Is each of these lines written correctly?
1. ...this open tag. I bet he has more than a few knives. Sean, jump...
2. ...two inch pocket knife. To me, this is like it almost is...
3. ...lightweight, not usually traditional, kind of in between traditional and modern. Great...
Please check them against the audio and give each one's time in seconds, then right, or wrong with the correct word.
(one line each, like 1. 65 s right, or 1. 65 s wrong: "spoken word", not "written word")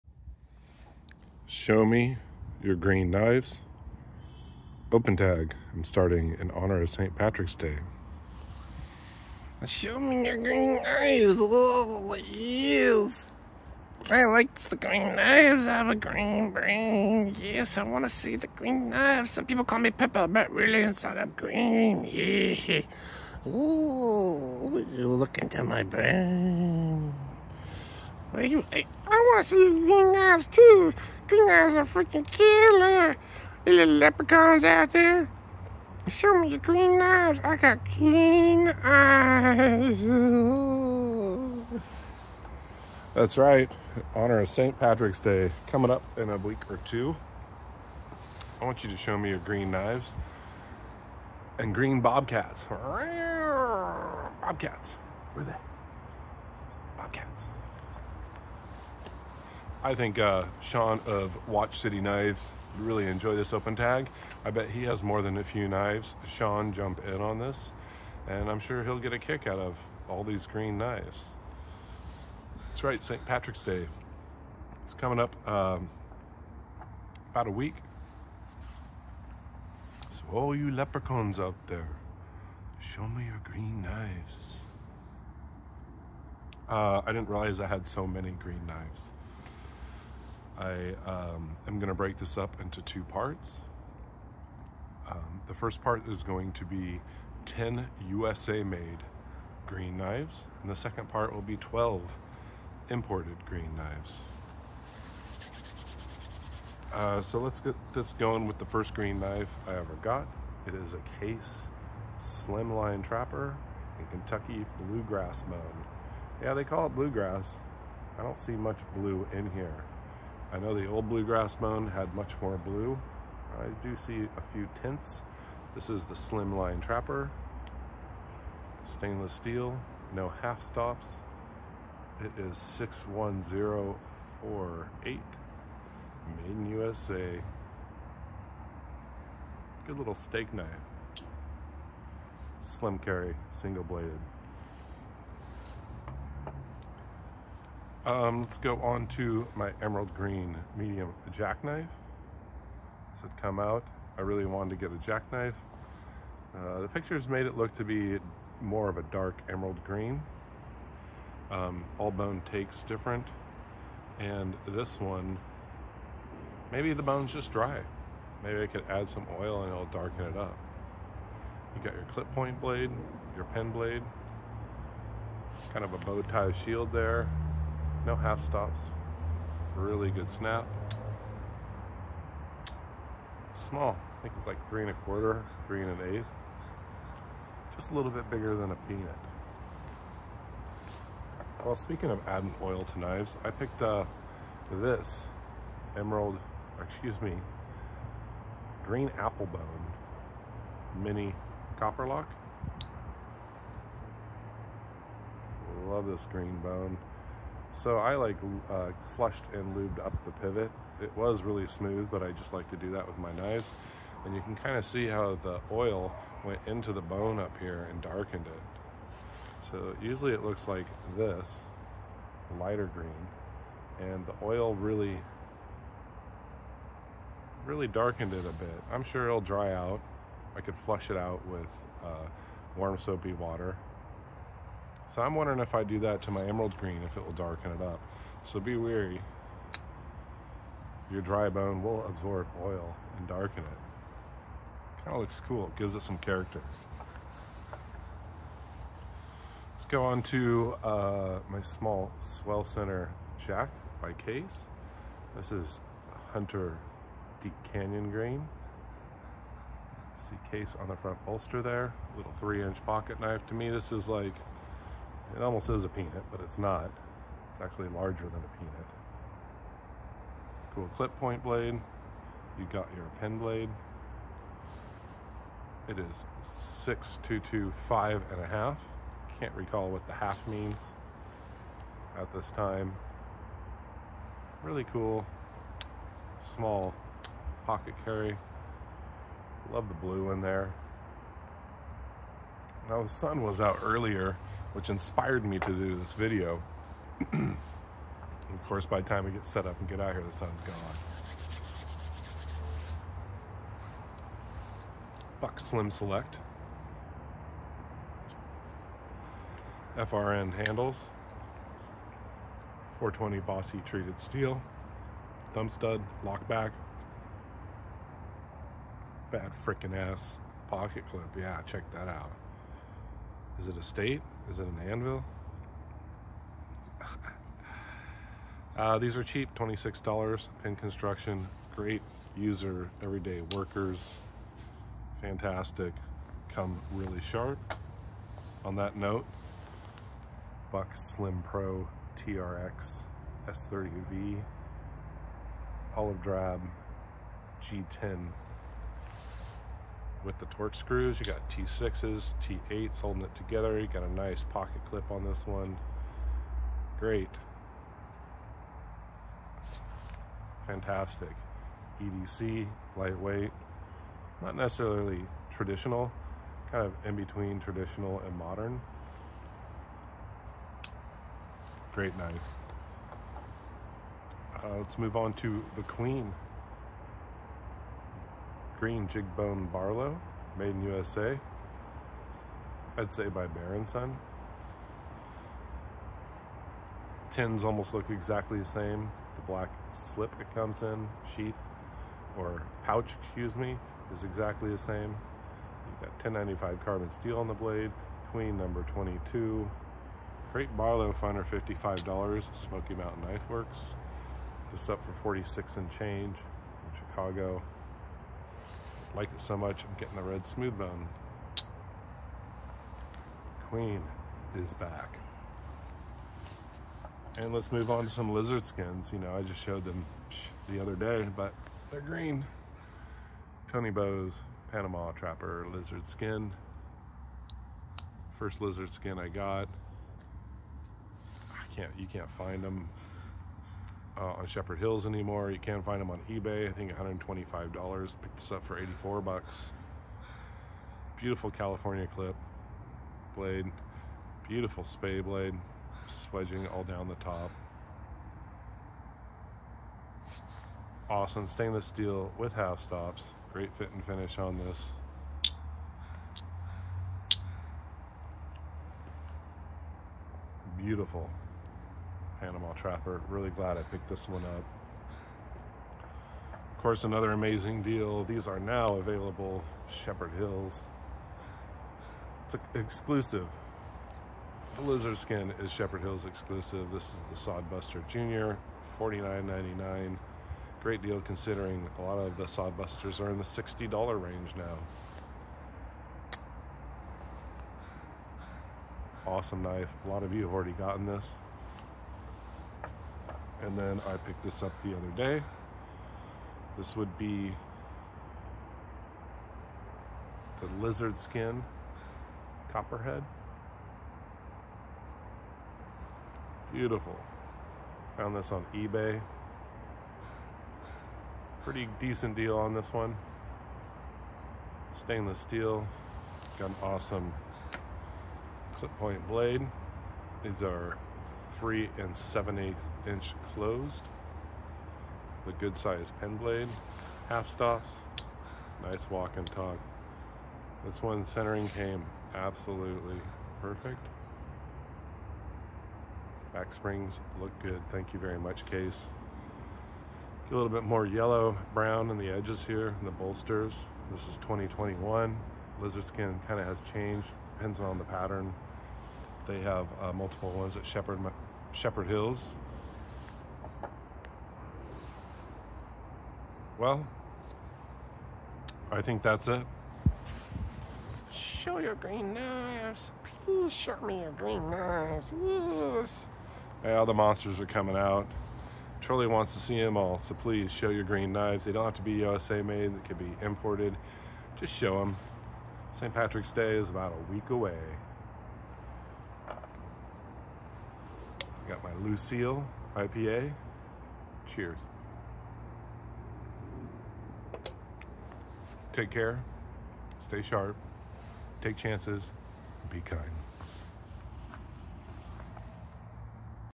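1. 63 s right
2. 262 s wrong: "three", not "two"
3. 362 s wrong: "necessarily", not "usually".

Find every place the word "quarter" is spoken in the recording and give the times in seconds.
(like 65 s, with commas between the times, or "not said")
184 s.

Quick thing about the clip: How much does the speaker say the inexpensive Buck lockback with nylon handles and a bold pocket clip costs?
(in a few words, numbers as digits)
$26.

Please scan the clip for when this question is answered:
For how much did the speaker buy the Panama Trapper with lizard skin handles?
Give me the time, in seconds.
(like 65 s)
438 s.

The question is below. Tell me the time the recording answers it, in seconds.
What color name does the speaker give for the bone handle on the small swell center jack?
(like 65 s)
256 s.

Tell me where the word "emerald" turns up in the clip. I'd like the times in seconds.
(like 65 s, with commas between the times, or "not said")
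149 s, 159 s, 195 s, 236 s.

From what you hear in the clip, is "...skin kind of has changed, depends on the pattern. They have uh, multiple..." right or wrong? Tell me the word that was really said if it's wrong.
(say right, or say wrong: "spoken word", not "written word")
right.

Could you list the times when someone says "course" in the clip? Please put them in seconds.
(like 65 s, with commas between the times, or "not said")
298 s, 466 s.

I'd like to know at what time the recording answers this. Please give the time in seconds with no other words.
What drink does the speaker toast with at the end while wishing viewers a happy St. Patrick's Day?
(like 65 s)
582 s.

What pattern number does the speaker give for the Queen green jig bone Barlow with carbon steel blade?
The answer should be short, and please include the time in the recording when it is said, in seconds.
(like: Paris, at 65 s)
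22, at 398 s.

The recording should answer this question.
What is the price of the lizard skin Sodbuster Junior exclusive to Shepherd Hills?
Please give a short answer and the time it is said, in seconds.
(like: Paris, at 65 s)
$49.99, at 478 s.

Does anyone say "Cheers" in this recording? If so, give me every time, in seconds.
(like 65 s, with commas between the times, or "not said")
584 s.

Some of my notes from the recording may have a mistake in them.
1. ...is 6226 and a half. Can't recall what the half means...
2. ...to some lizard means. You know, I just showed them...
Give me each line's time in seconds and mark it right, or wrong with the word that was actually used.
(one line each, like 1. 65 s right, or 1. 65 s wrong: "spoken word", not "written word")
1. 275 s wrong: "6225", not "6226"
2. 418 s wrong: "skins", not "means".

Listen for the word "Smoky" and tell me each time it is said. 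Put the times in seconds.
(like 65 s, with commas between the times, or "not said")
402 s.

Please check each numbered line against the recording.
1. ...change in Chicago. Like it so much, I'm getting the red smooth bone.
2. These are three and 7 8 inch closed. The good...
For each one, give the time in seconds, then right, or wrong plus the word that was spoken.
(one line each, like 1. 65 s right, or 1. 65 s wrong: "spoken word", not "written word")
1. 405 s right
2. 520 s right.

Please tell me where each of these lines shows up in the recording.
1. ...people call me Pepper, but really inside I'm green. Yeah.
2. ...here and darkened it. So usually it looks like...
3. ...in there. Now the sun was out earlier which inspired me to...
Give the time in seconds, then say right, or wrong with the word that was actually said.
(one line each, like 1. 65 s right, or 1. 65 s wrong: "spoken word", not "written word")
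1. 19 s right
2. 217 s right
3. 290 s right.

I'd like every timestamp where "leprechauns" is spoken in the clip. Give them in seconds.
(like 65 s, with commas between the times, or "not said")
33 s, 80 s.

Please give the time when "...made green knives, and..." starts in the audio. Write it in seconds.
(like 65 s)
98 s.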